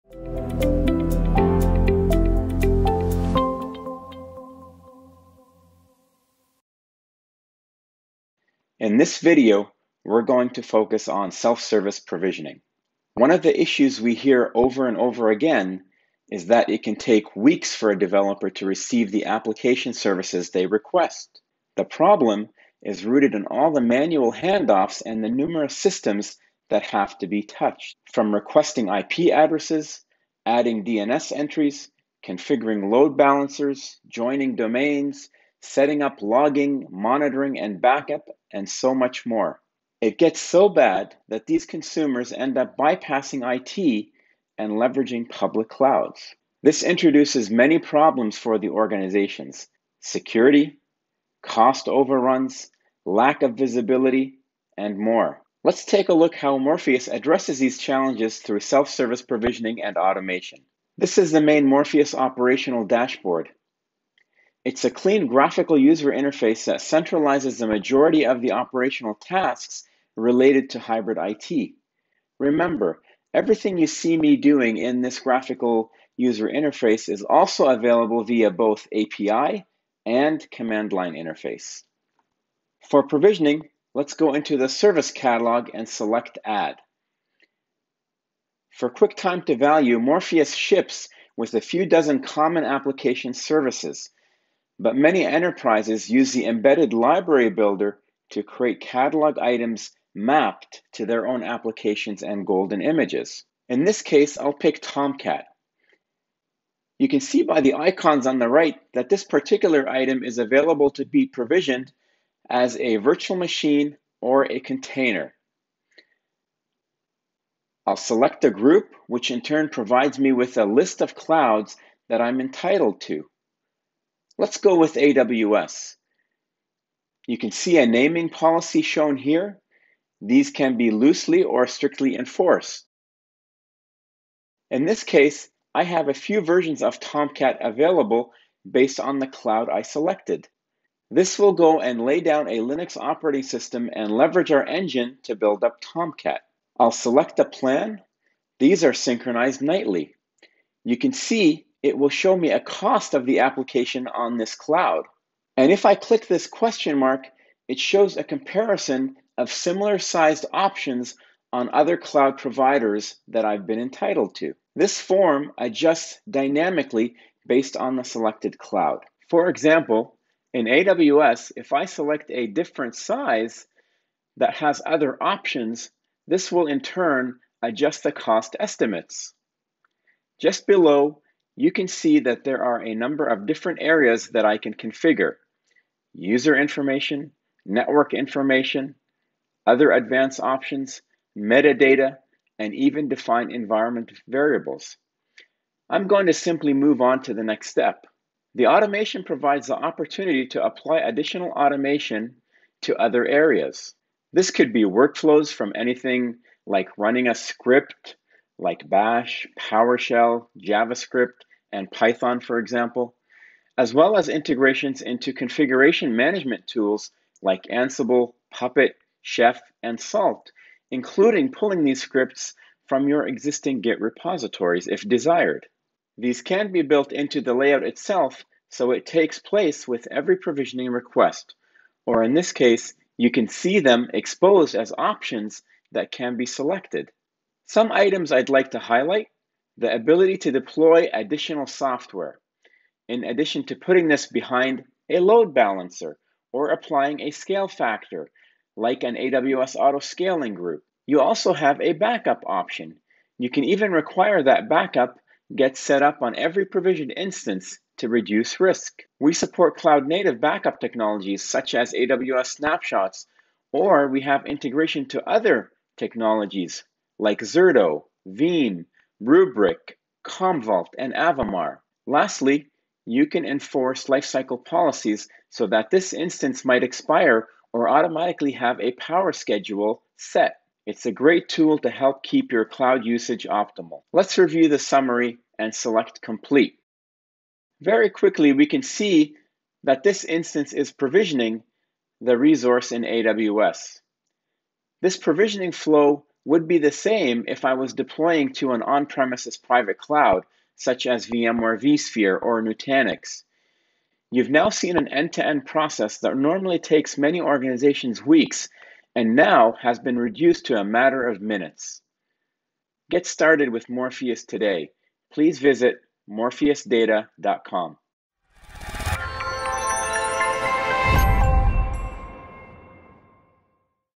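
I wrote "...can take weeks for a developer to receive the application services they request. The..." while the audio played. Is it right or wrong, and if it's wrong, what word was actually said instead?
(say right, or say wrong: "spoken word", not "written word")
right.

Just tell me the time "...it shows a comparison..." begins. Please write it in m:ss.
2:37.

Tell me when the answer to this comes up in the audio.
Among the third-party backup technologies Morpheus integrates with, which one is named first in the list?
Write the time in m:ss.
4:27.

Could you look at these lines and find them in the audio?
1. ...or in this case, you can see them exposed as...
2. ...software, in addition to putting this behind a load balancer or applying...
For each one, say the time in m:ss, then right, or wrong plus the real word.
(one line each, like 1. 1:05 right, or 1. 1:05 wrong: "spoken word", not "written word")
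1. 3:52 right
2. 4:01 right.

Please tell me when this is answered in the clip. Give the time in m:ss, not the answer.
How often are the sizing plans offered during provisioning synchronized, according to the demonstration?
2:29.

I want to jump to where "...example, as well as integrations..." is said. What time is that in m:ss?
3:32.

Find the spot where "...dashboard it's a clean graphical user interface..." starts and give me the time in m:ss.
1:02.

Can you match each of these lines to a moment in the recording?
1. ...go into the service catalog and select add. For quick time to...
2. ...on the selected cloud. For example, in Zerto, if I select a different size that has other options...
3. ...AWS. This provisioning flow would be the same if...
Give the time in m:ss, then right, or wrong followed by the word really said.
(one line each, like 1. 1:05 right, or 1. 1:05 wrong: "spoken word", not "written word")
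1. 1:24 right
2. 2:47 wrong: "AWS", not "Zerto"
3. 4:53 right.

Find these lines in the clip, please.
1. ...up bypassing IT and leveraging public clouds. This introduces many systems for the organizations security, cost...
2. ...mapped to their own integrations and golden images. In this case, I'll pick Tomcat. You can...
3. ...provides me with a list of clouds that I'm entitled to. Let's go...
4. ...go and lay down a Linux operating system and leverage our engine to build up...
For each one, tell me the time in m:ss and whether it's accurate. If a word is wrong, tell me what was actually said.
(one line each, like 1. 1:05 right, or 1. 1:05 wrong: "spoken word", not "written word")
1. 0:42 wrong: "problems", not "systems"
2. 1:40 wrong: "applications", not "integrations"
3. 1:59 right
4. 2:21 right.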